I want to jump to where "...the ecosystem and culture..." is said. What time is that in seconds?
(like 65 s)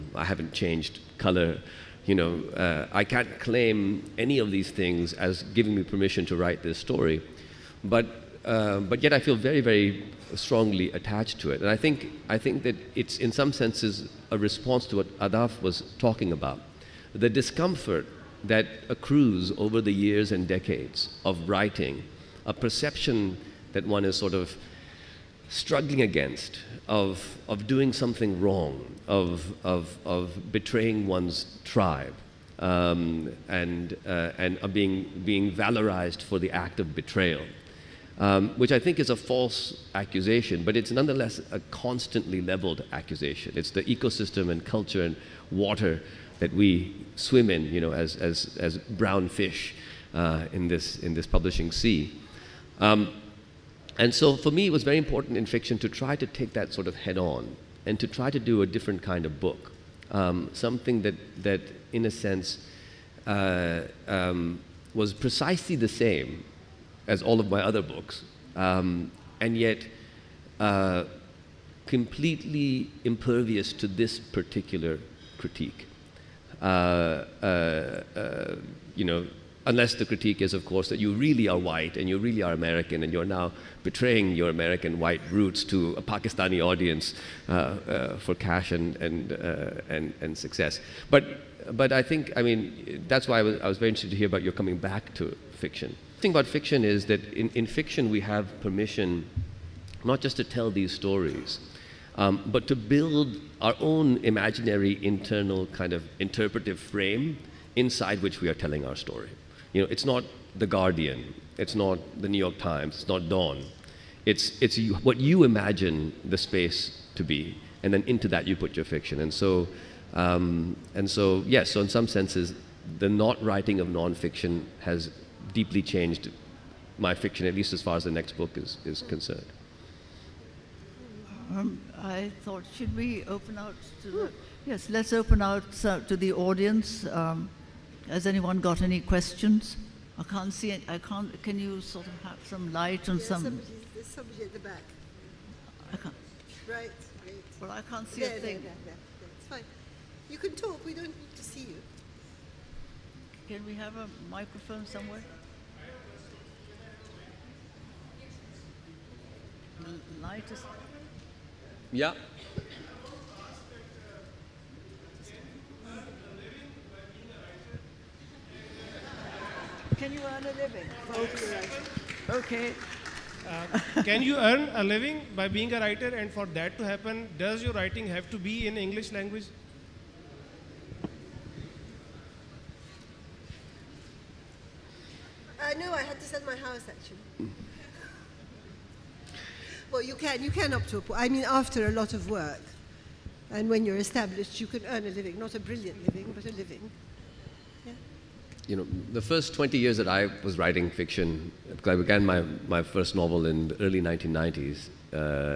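43 s.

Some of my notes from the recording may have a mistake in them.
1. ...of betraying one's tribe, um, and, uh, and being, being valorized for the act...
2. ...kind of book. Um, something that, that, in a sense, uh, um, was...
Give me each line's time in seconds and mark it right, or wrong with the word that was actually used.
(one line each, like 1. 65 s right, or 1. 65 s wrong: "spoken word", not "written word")
1. 30 s right
2. 59 s right.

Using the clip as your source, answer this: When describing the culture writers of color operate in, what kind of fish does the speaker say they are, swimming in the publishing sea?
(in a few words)
brown fish.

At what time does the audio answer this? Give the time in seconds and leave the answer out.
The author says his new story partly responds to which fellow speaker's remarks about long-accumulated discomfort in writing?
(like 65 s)
15 s.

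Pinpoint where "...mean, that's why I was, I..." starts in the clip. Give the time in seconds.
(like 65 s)
92 s.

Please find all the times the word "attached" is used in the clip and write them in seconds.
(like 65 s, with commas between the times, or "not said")
10 s.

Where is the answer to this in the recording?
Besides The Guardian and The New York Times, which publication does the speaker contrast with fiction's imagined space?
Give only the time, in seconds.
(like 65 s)
113 s.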